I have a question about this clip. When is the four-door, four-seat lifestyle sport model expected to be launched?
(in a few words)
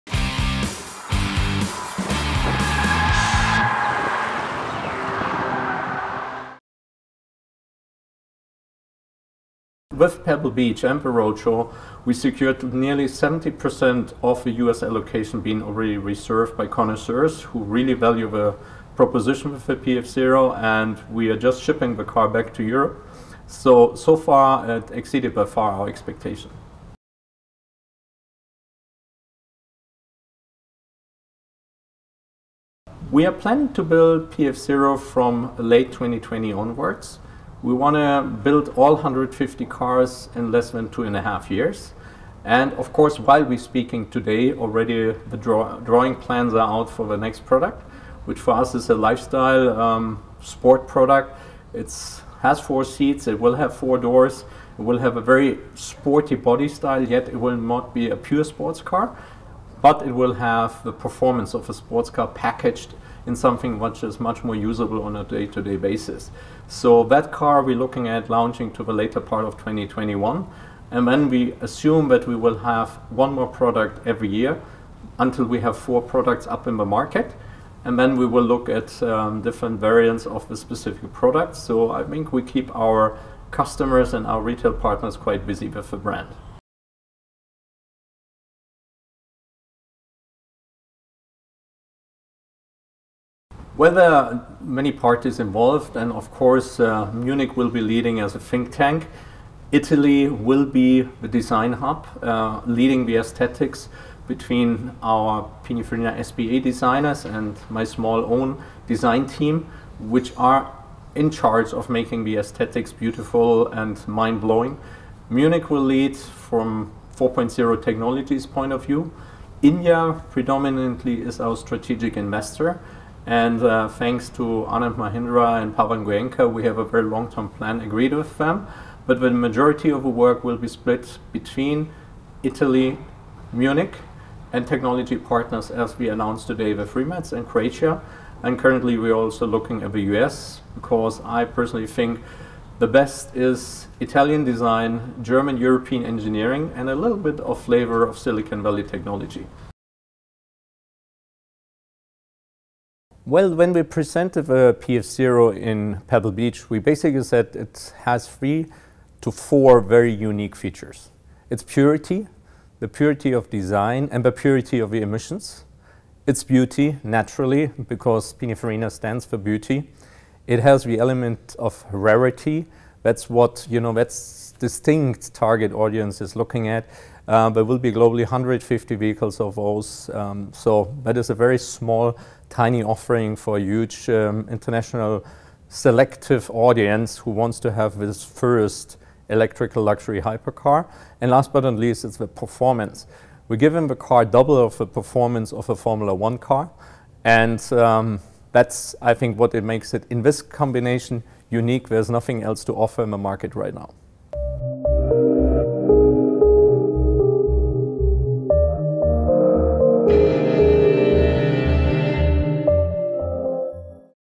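later part of 2021.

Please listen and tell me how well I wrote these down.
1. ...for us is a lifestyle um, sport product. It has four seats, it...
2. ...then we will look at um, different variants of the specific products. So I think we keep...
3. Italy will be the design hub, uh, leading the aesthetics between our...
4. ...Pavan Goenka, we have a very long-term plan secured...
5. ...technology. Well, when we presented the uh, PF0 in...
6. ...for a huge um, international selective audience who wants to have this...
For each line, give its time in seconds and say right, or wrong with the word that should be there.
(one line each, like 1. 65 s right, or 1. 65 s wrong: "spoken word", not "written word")
1. 48 s right
2. 77 s right
3. 99 s right
4. 125 s wrong: "agreed", not "secured"
5. 148 s right
6. 183 s right.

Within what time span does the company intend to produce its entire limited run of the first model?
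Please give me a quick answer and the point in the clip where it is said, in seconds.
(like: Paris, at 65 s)
less than 2.5 years, at 40 s.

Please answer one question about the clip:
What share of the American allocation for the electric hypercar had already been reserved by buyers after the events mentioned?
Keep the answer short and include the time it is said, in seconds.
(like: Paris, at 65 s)
nearly 70%, at 12 s.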